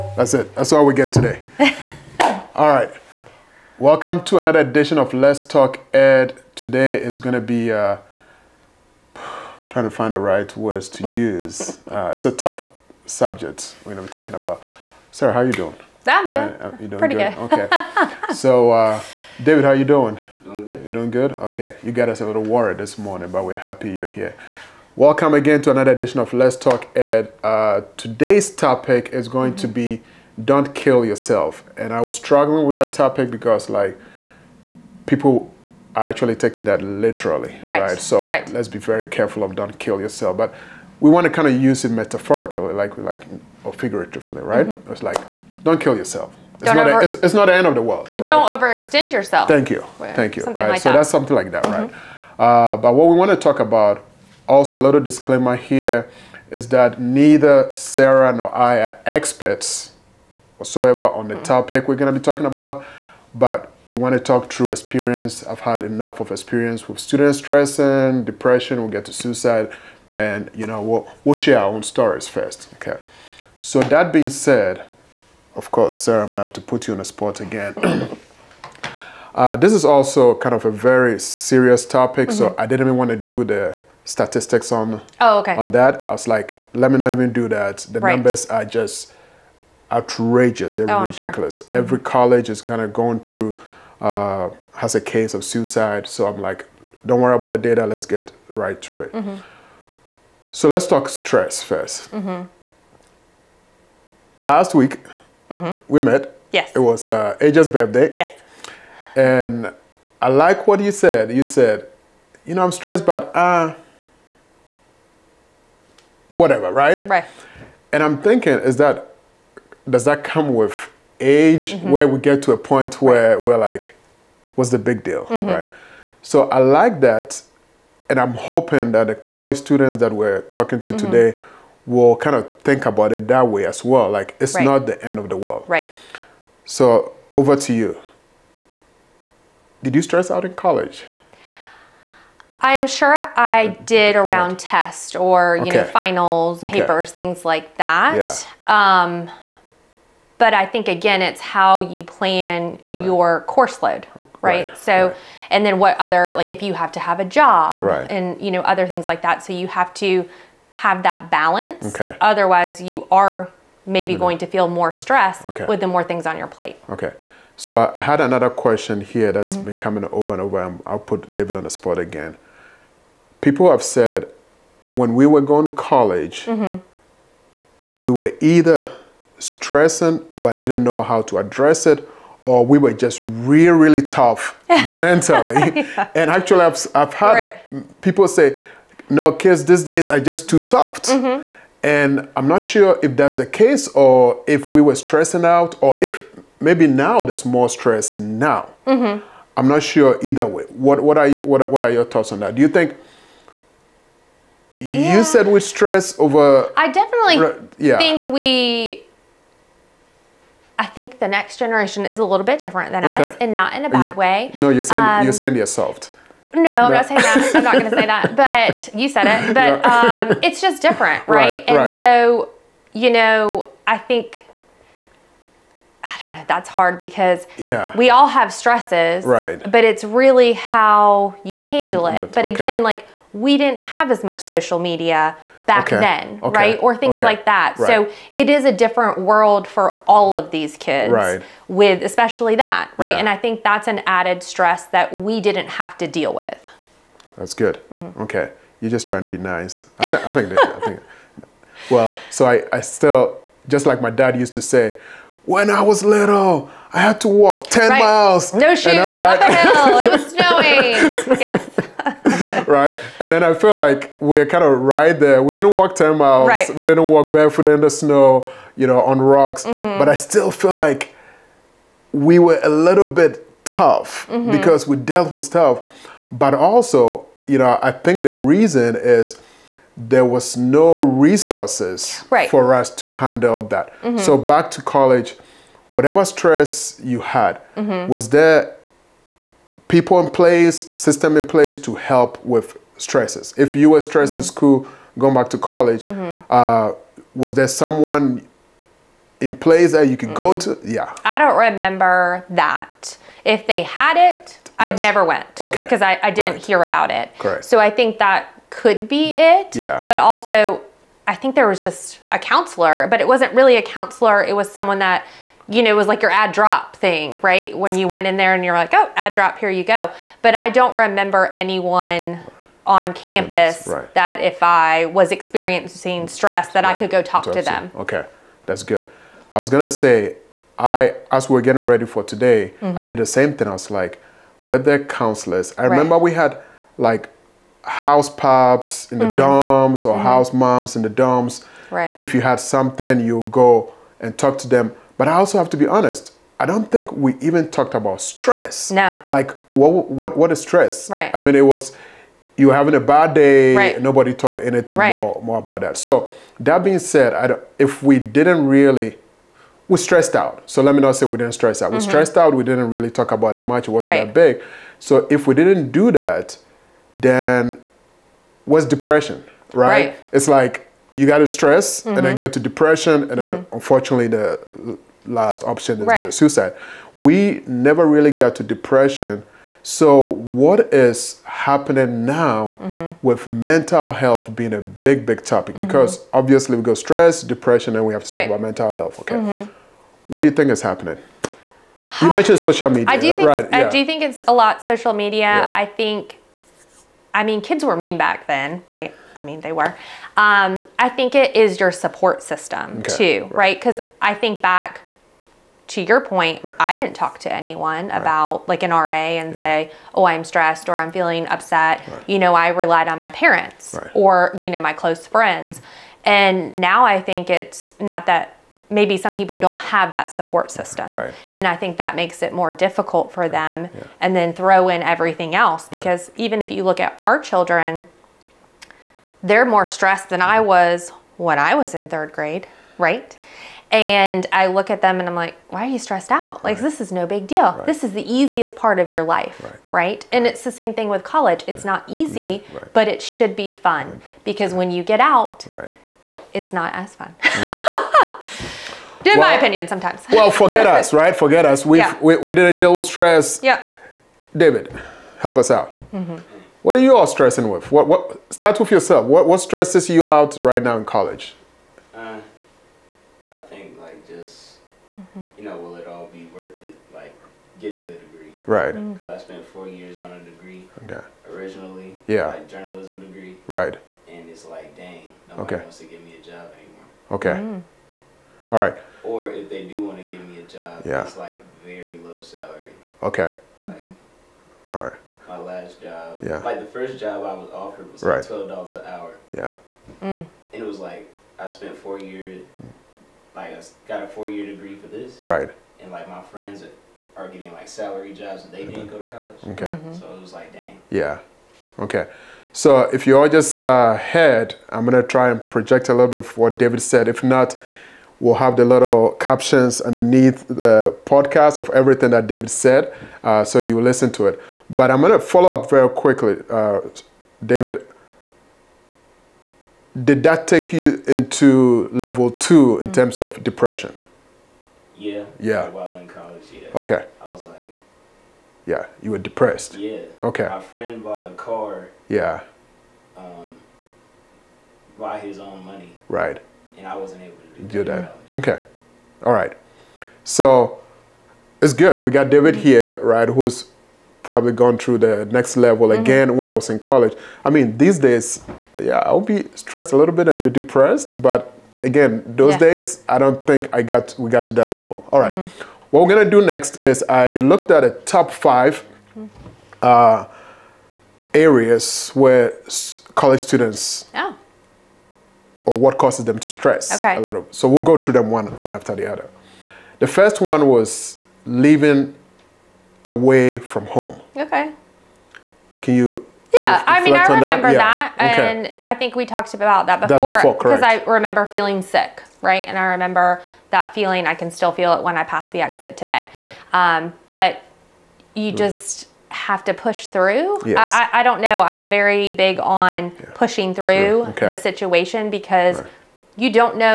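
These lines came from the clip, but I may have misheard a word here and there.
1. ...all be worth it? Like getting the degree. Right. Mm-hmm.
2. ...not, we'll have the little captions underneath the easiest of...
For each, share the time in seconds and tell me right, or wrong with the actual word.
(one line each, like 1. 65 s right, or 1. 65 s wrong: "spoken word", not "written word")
1. 466 s right
2. 507 s wrong: "podcast", not "easiest".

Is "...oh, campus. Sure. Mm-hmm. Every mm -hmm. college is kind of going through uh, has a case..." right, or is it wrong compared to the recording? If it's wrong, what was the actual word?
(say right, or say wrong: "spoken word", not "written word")
wrong: "ridiculous", not "campus".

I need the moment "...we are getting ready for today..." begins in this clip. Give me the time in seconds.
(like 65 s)
331 s.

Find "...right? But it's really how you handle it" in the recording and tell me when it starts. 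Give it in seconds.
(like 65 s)
229 s.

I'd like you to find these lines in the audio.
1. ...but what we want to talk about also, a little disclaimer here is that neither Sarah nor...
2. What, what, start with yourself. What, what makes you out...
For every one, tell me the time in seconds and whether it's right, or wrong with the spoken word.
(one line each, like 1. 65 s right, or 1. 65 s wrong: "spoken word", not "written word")
1. 52 s right
2. 457 s wrong: "stresses", not "makes".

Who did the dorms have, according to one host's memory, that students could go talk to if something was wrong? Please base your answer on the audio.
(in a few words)
House moms.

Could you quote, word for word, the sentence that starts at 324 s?
that if I was experiencing stress that right.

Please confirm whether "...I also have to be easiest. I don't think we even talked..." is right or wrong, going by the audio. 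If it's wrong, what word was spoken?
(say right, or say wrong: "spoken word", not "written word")
wrong: "honest", not "easiest".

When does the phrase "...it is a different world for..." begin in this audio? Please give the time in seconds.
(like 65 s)
238 s.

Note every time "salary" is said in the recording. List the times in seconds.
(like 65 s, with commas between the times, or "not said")
482 s, 497 s.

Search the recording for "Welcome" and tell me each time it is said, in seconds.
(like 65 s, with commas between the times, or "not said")
3 s, 24 s.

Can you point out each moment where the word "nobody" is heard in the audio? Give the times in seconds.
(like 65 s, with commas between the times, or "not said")
354 s, 475 s.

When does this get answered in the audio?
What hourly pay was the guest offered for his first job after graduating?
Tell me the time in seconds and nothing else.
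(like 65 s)
488 s.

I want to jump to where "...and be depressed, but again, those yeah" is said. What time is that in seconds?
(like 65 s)
550 s.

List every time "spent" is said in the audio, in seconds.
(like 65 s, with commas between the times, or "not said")
469 s, 491 s.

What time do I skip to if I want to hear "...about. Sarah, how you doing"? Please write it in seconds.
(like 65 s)
14 s.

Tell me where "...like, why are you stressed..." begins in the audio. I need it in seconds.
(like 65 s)
435 s.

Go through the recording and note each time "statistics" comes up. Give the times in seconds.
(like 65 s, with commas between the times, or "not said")
84 s.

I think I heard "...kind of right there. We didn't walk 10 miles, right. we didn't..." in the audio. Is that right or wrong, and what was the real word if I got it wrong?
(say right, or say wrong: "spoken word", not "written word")
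right.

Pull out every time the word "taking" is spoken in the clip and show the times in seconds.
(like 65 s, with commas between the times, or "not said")
36 s.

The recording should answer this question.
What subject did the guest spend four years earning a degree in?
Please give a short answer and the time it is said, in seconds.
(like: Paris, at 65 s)
Journalism, at 472 s.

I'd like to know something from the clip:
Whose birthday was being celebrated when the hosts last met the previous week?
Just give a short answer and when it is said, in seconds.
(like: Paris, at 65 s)
Aja, at 107 s.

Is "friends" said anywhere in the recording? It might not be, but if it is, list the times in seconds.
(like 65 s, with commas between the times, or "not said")
415 s, 496 s, 530 s.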